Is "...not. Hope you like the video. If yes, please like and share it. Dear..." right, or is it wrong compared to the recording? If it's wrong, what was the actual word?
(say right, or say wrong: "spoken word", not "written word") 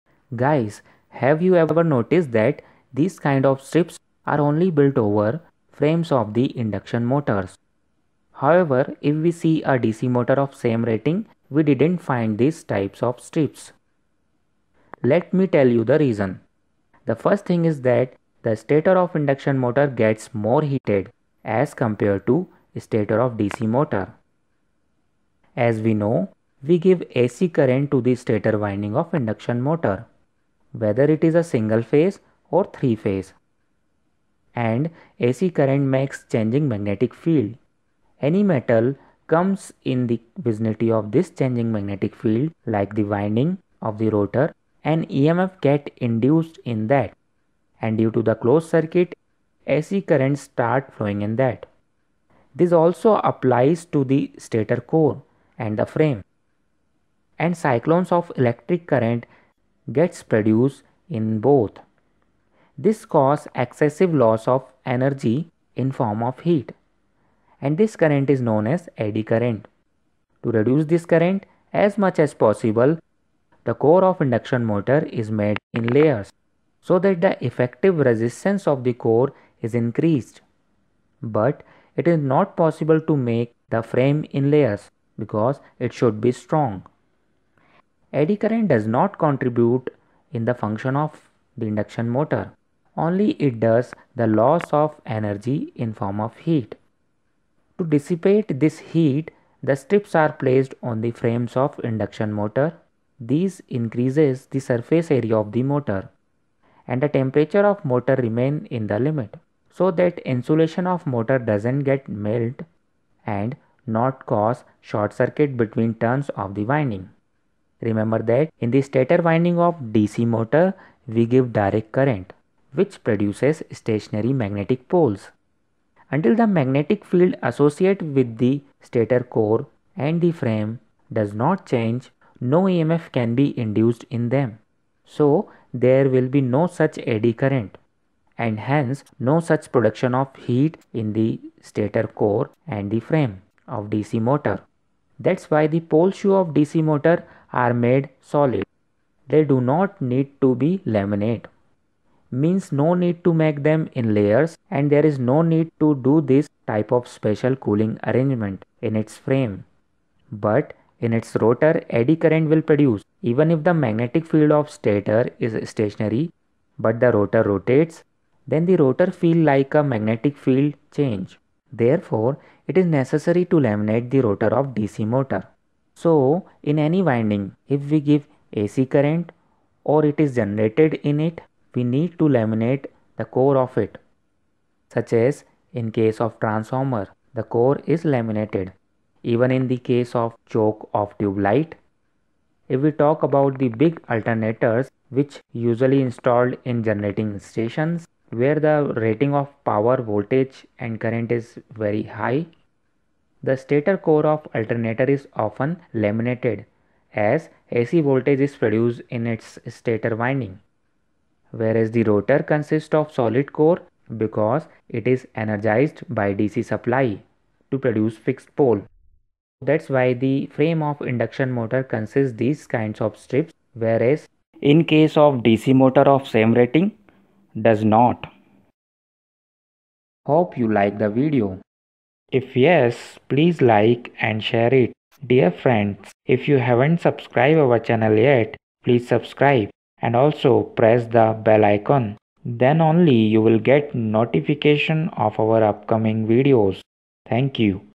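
right.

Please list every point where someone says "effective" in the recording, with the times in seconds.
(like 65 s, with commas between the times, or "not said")
77 s.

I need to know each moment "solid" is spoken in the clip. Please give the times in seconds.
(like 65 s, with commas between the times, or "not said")
148 s, 213 s.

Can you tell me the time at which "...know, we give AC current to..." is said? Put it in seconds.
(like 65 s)
25 s.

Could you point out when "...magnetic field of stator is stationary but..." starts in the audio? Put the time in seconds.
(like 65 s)
163 s.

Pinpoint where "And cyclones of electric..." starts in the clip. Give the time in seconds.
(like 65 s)
57 s.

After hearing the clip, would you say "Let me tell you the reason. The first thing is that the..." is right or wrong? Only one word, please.
right.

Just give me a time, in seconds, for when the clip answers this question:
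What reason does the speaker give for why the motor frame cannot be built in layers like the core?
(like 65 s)
85 s.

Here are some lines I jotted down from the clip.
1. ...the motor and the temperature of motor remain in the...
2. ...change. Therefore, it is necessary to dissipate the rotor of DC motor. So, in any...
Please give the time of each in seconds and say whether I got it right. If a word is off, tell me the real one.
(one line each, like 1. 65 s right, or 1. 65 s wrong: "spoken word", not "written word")
1. 105 s right
2. 170 s wrong: "laminate", not "dissipate".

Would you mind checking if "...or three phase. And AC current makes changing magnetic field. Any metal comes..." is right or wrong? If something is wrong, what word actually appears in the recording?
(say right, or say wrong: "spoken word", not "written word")
right.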